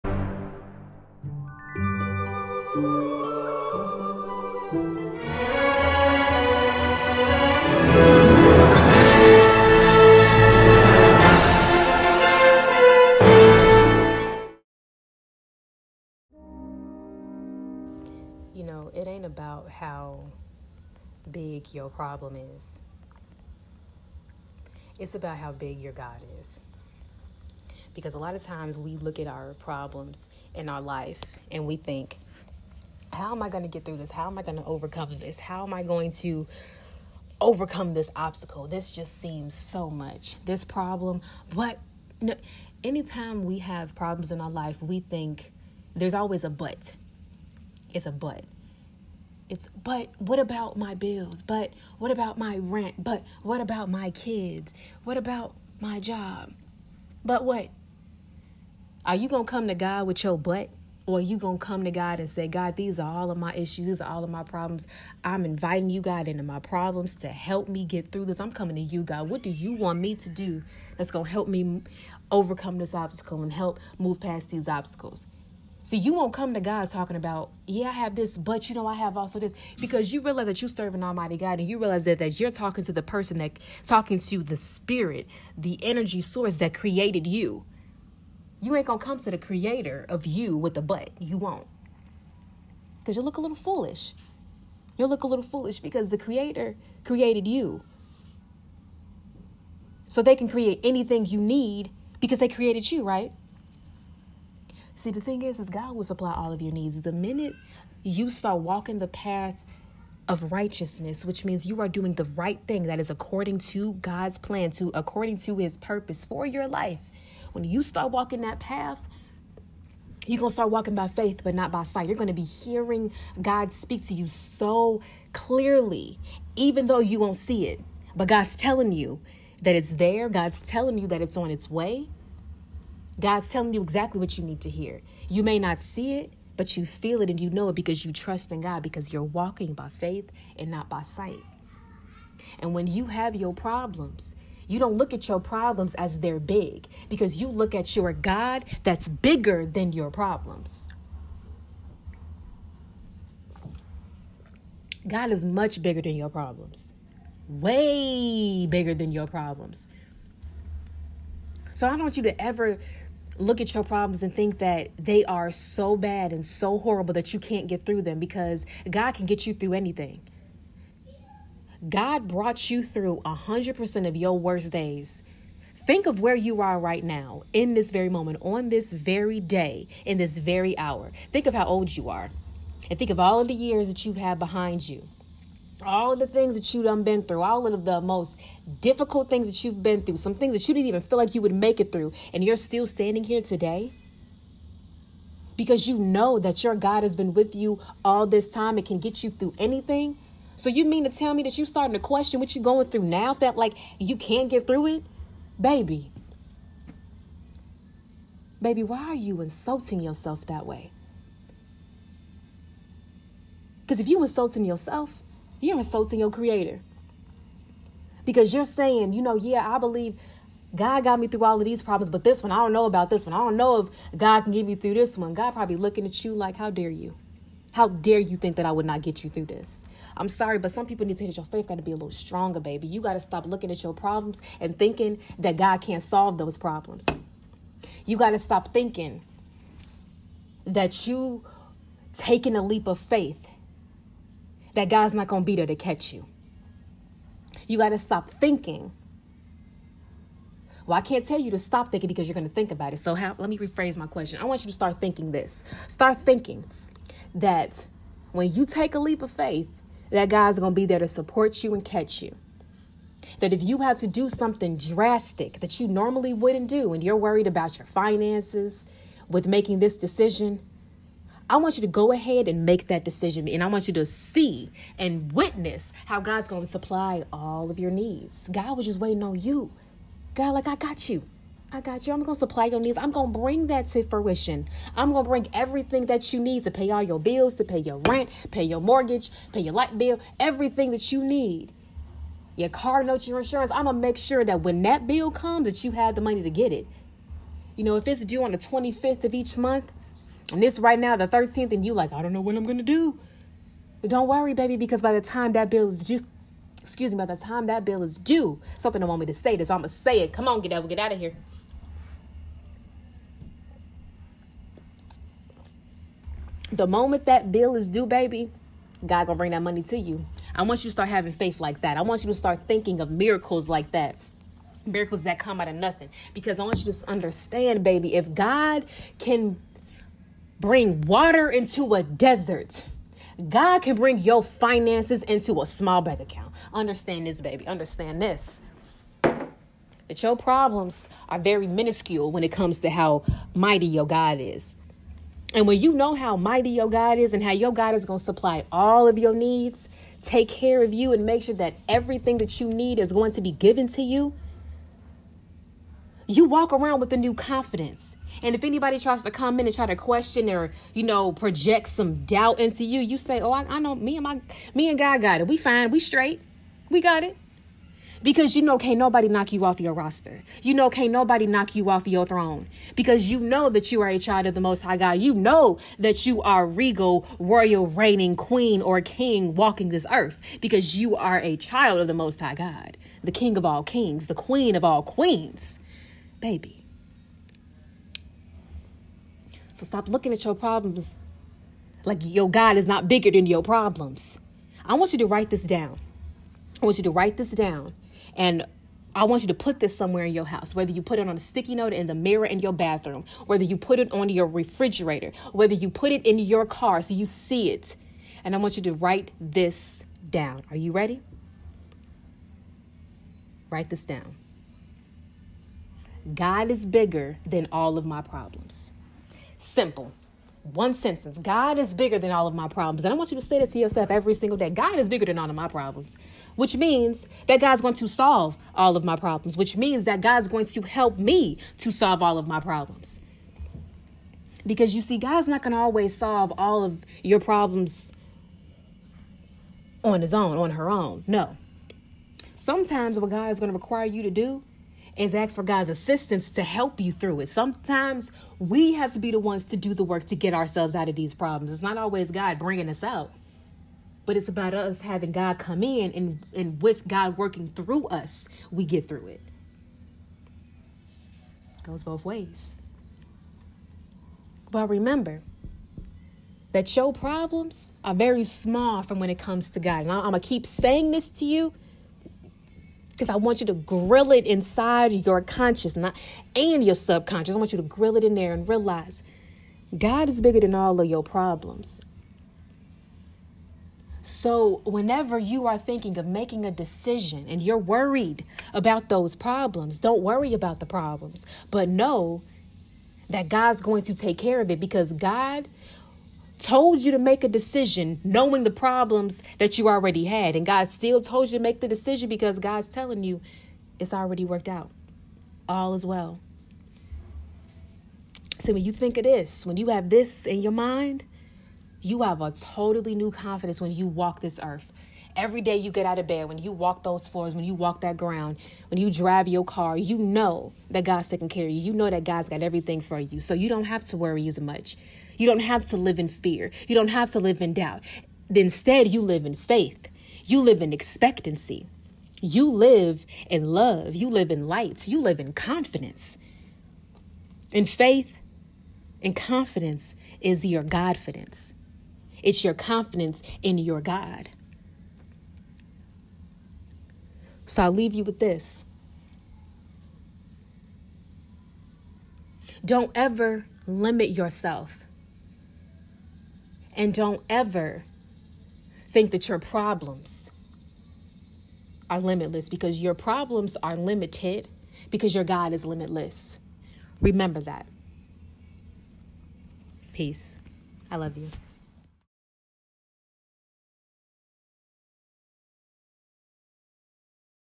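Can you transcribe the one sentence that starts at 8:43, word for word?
So you don't have to worry as much.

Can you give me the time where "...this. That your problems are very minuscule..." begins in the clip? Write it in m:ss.
5:38.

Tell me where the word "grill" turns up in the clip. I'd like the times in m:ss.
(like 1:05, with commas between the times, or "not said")
7:53, 7:57.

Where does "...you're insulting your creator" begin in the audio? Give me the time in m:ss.
3:35.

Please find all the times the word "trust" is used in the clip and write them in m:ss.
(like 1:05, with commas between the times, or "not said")
2:18.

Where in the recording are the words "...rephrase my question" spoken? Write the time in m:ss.
4:13.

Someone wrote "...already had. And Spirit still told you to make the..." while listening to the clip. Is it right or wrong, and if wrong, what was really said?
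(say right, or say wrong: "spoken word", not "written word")
wrong: "God", not "Spirit".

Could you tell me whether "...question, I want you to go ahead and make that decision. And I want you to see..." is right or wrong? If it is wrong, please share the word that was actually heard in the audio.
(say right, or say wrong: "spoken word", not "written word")
wrong: "decision", not "question".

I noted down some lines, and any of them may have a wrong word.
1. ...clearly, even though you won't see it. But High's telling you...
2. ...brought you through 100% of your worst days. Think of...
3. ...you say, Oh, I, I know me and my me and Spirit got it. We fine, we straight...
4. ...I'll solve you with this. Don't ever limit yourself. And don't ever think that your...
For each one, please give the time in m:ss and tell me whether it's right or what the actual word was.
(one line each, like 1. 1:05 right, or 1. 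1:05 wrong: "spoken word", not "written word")
1. 2:05 wrong: "God", not "High"
2. 2:52 right
3. 6:03 wrong: "God", not "Spirit"
4. 9:07 wrong: "leave", not "solve".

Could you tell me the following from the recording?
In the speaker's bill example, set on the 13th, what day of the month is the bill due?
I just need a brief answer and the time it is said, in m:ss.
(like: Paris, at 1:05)
25th, at 4:58.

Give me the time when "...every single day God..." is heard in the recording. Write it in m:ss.
7:04.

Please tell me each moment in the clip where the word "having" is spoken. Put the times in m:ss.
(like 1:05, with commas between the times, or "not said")
5:21, 7:35.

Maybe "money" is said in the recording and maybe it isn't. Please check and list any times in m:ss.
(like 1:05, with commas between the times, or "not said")
4:56, 5:19.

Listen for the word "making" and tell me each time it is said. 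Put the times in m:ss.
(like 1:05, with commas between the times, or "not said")
4:29, 8:06.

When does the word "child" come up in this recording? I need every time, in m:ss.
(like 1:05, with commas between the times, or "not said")
6:14, 6:21.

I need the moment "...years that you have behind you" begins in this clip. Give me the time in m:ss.
3:03.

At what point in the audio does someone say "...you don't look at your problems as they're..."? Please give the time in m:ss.
2:24.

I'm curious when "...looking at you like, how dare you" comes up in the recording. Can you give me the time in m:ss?
3:45.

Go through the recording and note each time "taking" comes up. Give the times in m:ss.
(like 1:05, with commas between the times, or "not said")
4:02, 8:41.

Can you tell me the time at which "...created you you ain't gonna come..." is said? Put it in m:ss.
1:26.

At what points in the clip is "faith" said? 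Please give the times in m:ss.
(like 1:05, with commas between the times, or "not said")
2:01, 2:19, 3:51, 4:02, 4:19, 5:21, 8:49, 8:57.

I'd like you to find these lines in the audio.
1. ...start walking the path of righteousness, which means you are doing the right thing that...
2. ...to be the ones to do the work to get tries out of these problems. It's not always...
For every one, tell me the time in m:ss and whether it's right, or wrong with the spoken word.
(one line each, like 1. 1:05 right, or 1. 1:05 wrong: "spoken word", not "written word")
1. 1:48 right
2. 7:29 wrong: "ourselves", not "tries".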